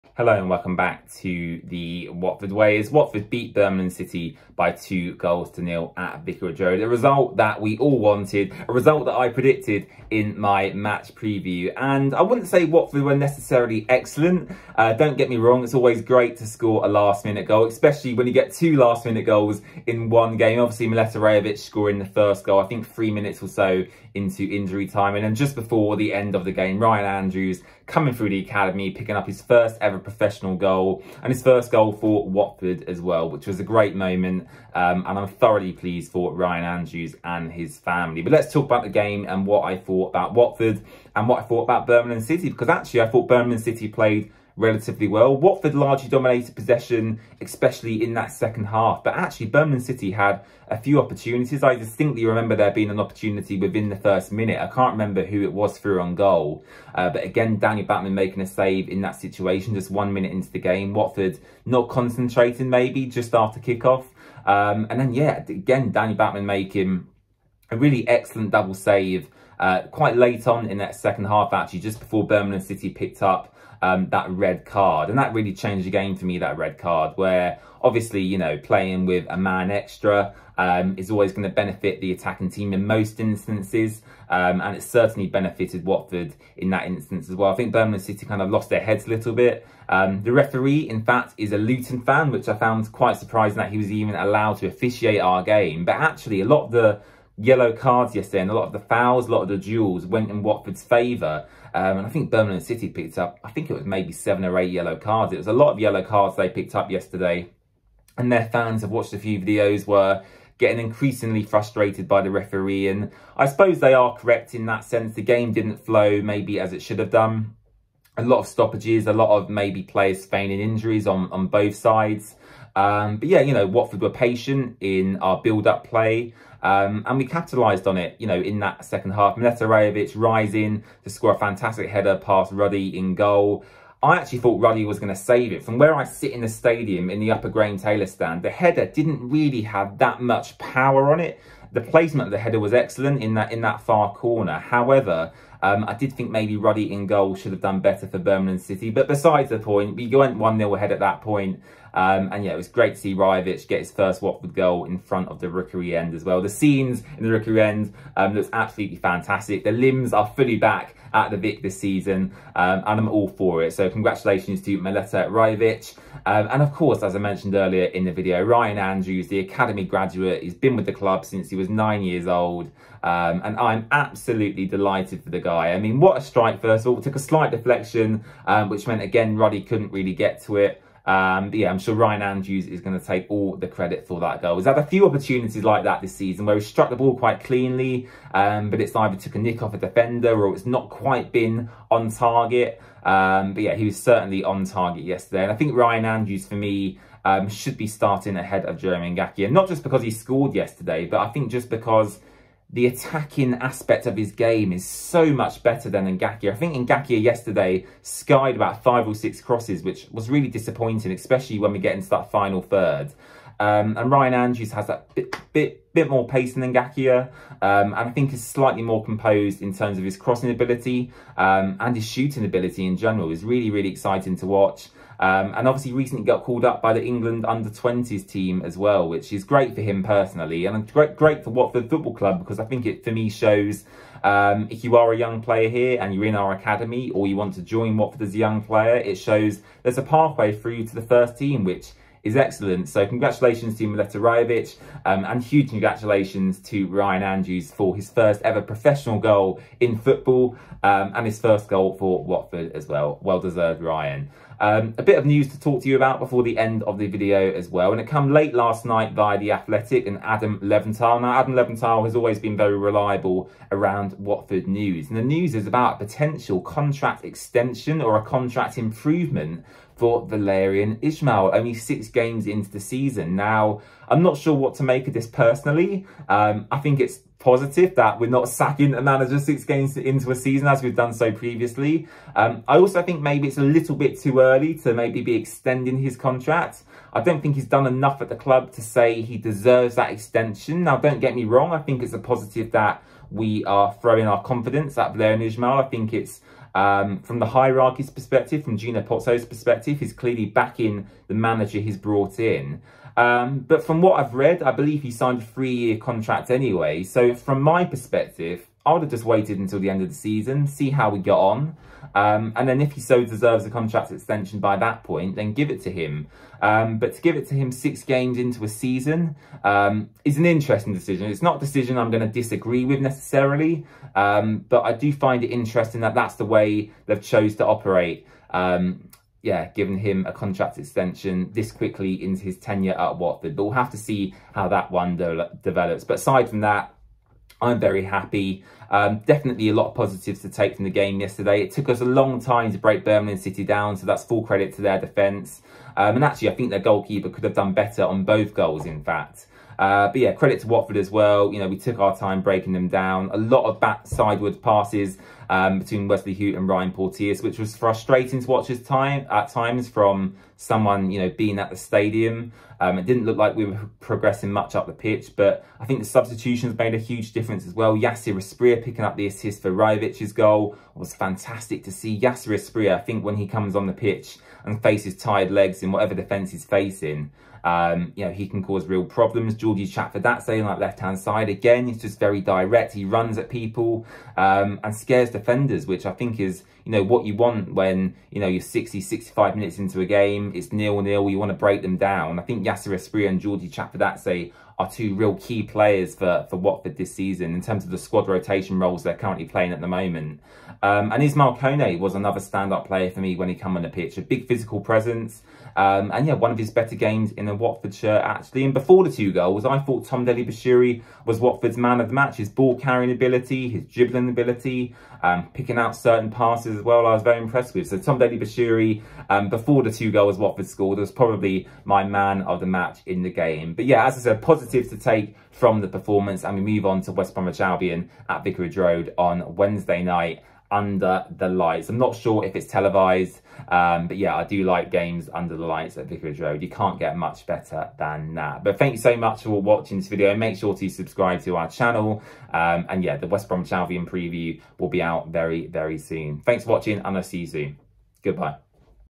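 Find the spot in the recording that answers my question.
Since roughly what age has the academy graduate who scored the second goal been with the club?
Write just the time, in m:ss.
2:51.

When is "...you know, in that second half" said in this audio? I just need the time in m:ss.
2:08.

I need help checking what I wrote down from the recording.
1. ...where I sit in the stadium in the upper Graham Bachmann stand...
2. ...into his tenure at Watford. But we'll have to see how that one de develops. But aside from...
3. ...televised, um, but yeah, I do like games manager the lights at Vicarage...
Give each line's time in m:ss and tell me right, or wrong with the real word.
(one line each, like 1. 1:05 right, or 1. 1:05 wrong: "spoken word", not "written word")
1. 2:15 wrong: "Taylor", not "Bachmann"
2. 5:32 right
3. 7:12 wrong: "under", not "manager".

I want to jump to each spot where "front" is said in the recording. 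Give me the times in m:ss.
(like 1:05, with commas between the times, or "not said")
2:34.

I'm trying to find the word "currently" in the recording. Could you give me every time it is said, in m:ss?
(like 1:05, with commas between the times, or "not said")
6:39.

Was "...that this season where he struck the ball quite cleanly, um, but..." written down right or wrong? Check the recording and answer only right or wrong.
right.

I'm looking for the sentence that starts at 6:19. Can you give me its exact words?
Giorgi Chakvetadze saying like left-hand side.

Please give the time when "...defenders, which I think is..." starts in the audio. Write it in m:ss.
6:25.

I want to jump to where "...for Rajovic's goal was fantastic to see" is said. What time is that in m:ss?
6:09.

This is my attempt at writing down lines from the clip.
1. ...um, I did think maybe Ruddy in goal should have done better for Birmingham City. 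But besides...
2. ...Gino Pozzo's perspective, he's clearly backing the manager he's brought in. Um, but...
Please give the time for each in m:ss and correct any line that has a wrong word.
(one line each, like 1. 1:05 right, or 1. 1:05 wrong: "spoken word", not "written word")
1. 2:25 right
2. 4:58 right.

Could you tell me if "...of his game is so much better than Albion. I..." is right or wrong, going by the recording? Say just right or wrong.
wrong.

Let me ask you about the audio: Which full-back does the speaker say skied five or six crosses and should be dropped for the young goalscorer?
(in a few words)
Jeremy Ngakia.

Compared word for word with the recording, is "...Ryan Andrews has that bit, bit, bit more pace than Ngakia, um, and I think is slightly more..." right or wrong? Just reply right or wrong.
right.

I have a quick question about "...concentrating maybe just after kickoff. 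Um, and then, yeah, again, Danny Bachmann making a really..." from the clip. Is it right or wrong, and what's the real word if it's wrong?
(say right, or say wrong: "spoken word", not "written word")
right.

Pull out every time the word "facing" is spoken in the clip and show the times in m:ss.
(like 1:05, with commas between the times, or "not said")
6:16.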